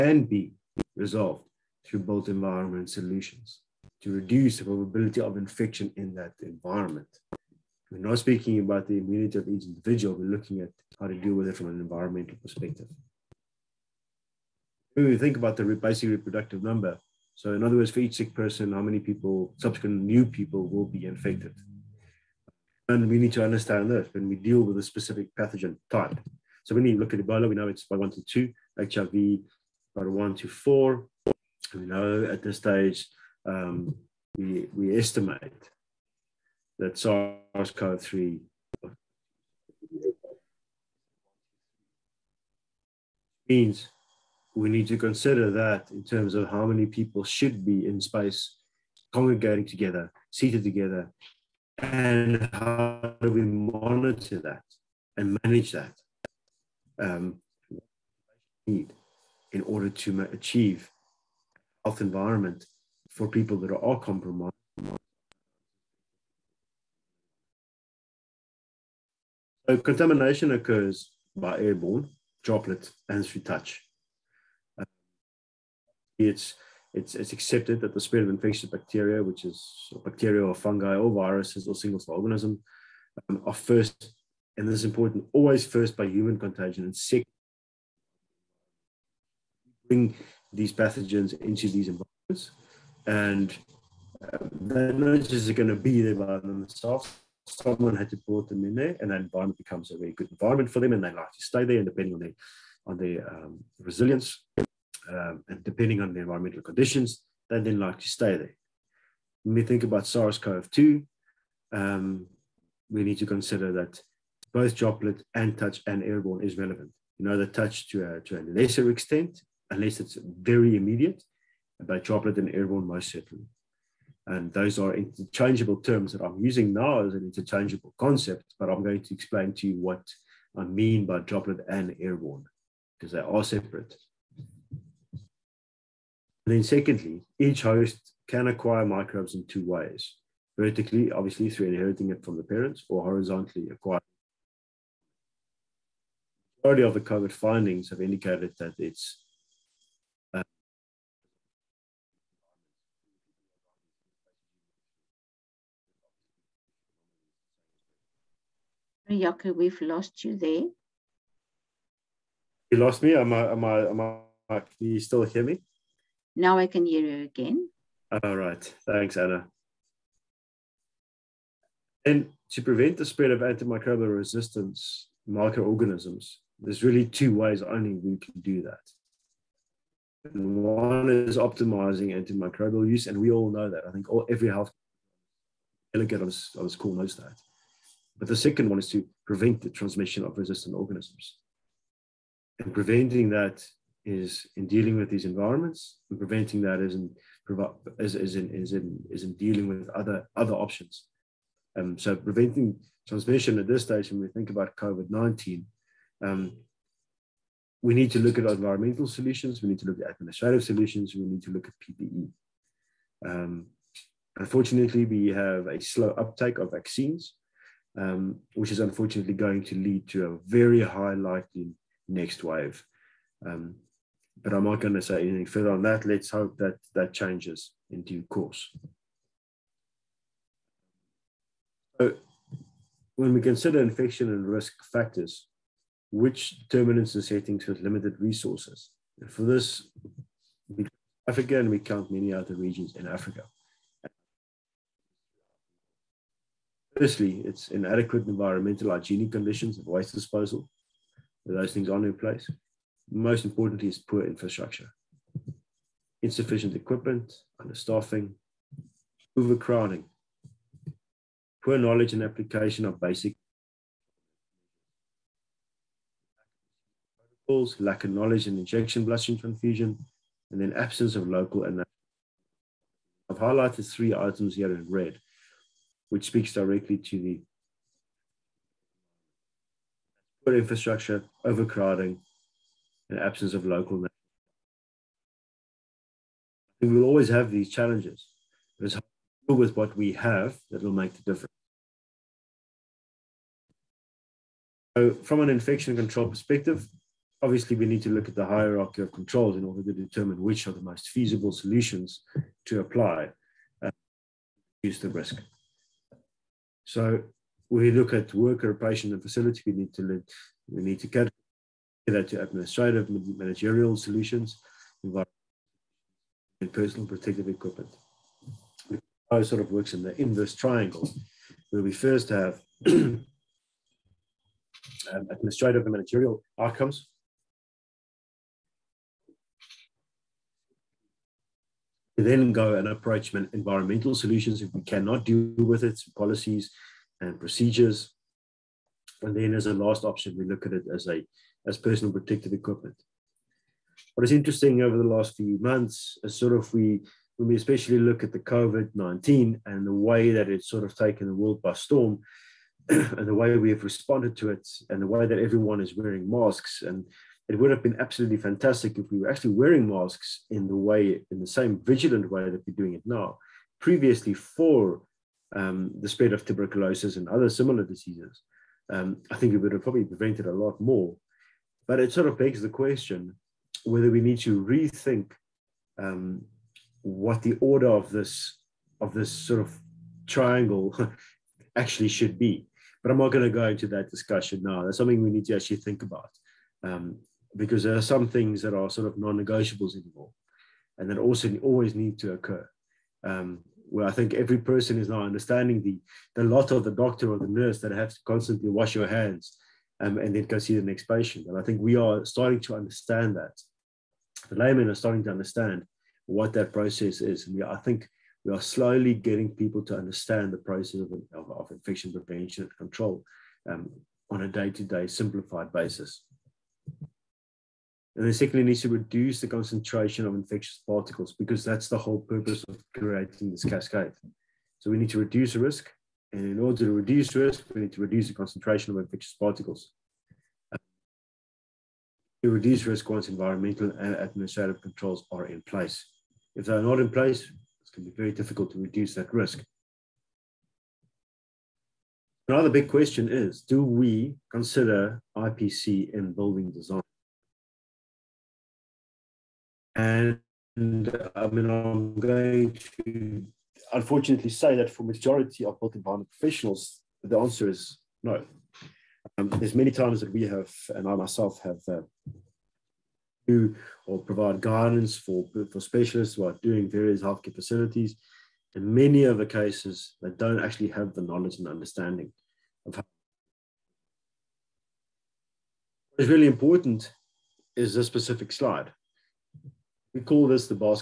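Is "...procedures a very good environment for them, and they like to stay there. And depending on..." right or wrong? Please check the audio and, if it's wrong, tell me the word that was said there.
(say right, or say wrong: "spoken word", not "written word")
wrong: "becomes", not "procedures".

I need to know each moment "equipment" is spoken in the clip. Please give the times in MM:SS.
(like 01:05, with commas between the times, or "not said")
04:16, 05:17, 05:42.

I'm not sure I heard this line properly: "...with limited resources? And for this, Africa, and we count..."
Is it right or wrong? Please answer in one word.
right.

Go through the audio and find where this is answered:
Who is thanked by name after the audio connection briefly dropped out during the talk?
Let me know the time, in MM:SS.
02:49.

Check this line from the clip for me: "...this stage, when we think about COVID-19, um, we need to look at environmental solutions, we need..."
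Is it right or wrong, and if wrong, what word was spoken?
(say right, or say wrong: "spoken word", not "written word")
right.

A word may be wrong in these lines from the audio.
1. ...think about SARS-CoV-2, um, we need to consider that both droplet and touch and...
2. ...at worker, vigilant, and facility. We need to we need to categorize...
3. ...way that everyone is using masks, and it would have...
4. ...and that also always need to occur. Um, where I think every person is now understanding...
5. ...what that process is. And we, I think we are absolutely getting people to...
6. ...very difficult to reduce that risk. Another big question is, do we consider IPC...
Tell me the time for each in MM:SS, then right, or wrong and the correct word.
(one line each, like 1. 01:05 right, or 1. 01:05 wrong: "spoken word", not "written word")
1. 01:49 right
2. 05:08 wrong: "patient", not "vigilant"
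3. 05:55 wrong: "wearing", not "using"
4. 06:30 right
5. 06:46 wrong: "slowly", not "absolutely"
6. 07:18 right.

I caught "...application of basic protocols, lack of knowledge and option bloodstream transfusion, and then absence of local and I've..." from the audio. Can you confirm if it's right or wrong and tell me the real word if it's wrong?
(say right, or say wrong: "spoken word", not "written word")
wrong: "injection", not "option".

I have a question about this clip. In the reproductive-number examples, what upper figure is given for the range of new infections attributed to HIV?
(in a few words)
4.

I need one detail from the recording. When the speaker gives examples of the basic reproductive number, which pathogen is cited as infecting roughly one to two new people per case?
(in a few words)
Ebola.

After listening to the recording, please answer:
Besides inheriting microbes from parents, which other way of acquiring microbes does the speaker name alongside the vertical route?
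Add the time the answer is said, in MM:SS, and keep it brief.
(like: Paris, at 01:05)
horizontally, at 02:23.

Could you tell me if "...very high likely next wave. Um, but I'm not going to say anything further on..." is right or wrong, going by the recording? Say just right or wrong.
right.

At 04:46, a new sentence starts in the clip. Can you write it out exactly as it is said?
We will always have these challenges, but it's how deal with what we have that will make the difference.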